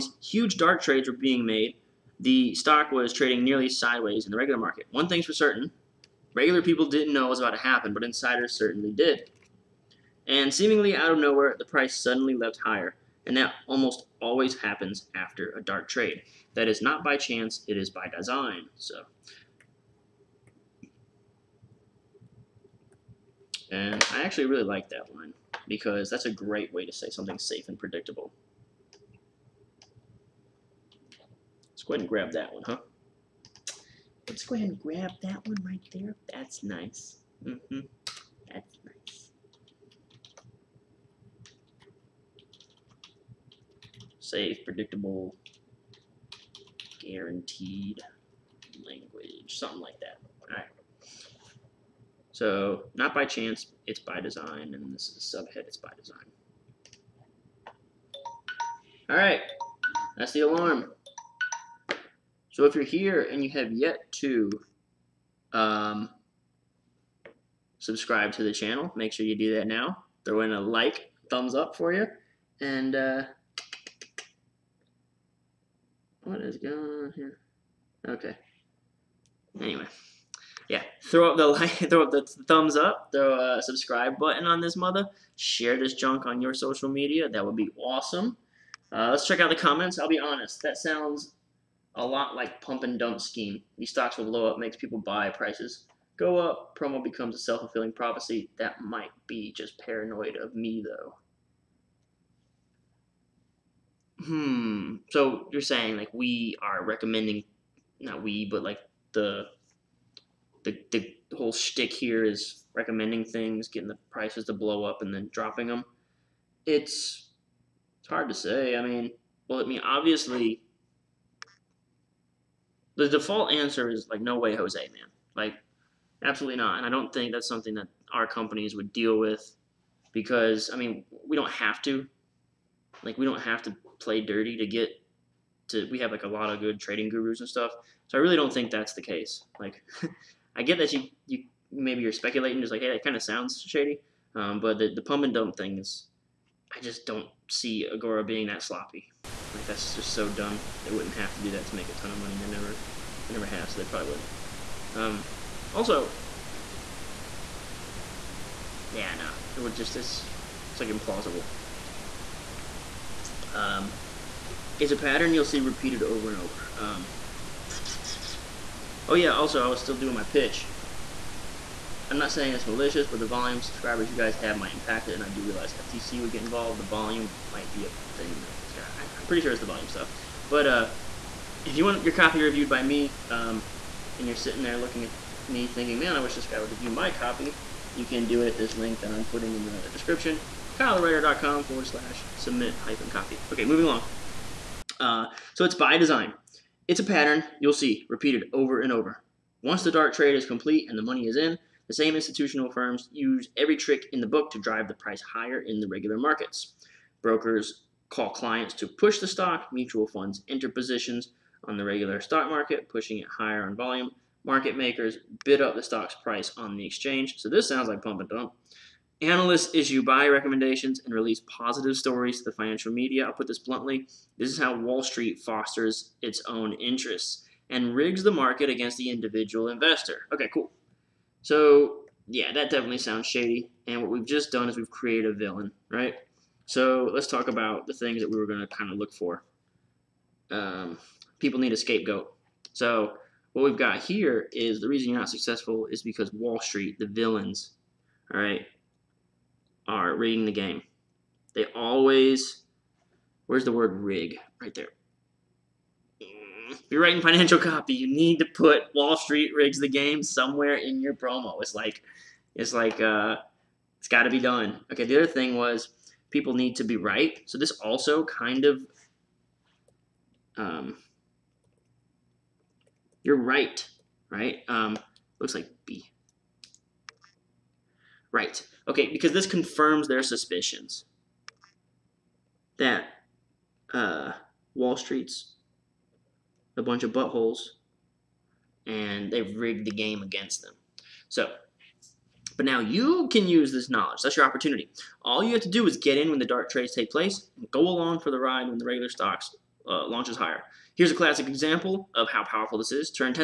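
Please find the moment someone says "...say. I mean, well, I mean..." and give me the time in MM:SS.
01:58.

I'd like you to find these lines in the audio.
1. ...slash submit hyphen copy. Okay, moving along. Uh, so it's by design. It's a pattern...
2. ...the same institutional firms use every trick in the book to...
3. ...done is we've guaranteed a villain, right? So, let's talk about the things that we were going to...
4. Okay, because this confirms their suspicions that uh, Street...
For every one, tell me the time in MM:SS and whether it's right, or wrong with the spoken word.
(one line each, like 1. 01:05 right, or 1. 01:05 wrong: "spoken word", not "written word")
1. 03:11 right
2. 03:21 right
3. 03:54 wrong: "created", not "guaranteed"
4. 04:38 wrong: "Wall", not "Street".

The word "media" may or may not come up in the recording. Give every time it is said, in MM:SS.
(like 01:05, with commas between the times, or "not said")
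01:26, 03:42.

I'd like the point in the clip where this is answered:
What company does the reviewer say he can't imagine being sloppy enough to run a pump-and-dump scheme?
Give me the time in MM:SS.
02:27.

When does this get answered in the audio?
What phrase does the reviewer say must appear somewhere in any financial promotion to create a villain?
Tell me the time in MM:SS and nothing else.
04:18.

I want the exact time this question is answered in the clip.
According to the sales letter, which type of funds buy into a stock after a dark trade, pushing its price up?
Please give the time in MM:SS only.
03:29.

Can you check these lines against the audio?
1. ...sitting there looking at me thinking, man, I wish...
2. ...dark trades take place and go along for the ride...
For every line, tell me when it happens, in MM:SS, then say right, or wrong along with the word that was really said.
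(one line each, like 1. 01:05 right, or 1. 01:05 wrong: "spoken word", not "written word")
1. 03:04 right
2. 04:56 right.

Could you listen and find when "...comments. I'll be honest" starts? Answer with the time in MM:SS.
01:29.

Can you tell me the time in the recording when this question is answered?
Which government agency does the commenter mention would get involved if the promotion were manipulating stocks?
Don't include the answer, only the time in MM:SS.
02:55.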